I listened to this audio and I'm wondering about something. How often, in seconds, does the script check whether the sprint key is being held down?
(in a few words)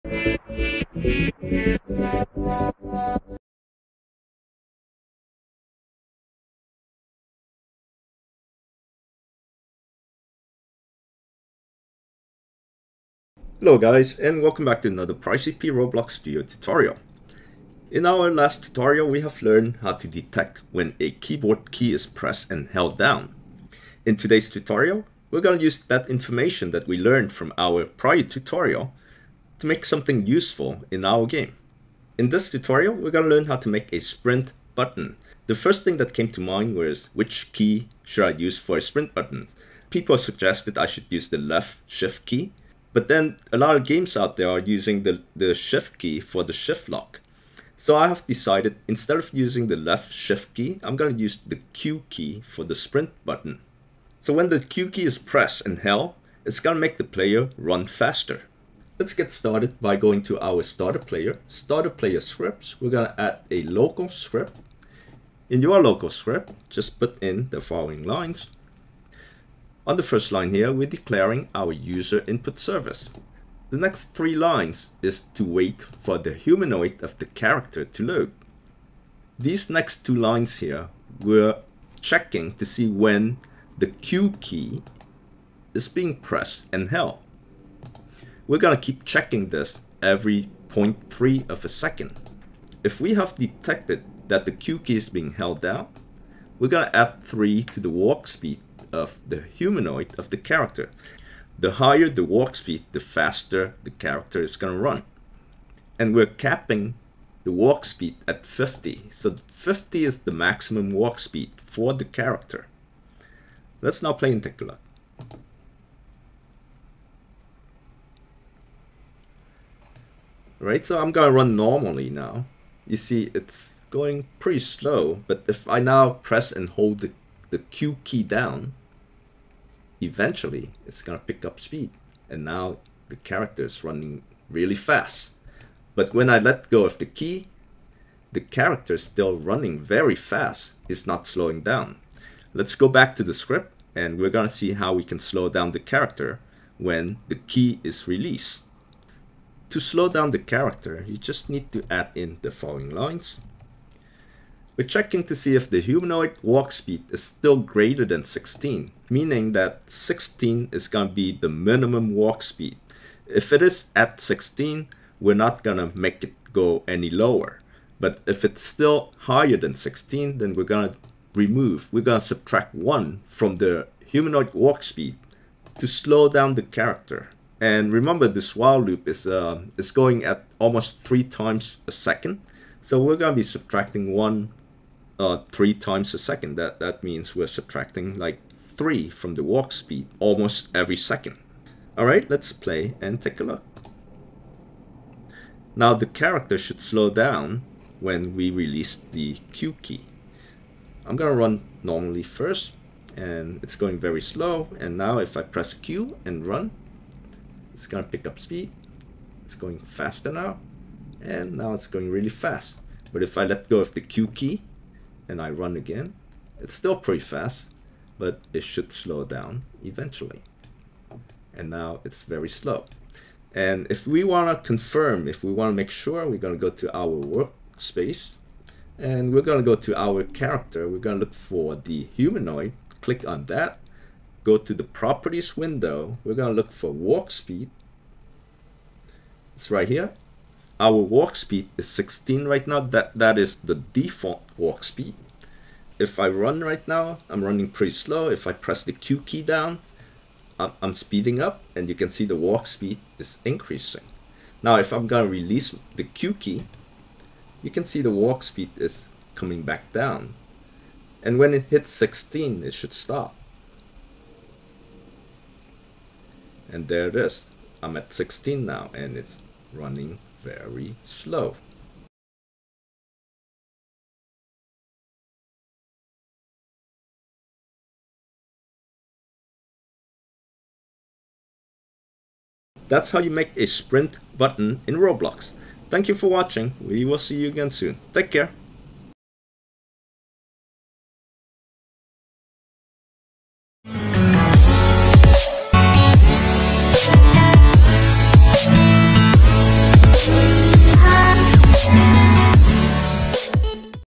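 0.3.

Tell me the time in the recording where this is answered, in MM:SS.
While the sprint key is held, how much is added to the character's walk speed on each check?
01:36.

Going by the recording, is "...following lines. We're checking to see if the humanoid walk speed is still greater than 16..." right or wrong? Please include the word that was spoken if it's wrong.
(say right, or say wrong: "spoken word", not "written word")
right.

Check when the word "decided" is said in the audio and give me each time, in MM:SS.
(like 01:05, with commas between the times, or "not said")
00:48.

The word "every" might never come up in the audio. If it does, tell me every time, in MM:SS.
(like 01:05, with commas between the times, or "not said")
01:30, 03:10.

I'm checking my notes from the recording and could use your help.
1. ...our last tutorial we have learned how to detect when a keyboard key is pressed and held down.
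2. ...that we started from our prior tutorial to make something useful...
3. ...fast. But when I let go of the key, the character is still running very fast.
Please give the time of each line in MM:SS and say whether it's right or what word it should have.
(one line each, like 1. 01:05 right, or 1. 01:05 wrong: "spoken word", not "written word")
1. 00:18 right
2. 00:26 wrong: "learned", not "started"
3. 02:14 right.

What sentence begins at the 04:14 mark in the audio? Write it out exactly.
Now, if I'm gonna release the Q key, you can see the walk speed is coming back down.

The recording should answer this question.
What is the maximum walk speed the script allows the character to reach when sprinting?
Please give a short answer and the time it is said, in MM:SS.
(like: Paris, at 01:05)
50, at 01:46.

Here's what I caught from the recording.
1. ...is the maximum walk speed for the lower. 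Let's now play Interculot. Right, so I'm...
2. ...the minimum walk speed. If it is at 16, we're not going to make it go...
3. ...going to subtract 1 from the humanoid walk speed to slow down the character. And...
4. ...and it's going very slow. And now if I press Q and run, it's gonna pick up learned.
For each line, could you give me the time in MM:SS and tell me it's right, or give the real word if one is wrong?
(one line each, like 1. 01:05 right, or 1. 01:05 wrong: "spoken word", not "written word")
1. 01:50 wrong: "character", not "lower"
2. 02:41 right
3. 02:52 right
4. 03:23 wrong: "speed", not "learned".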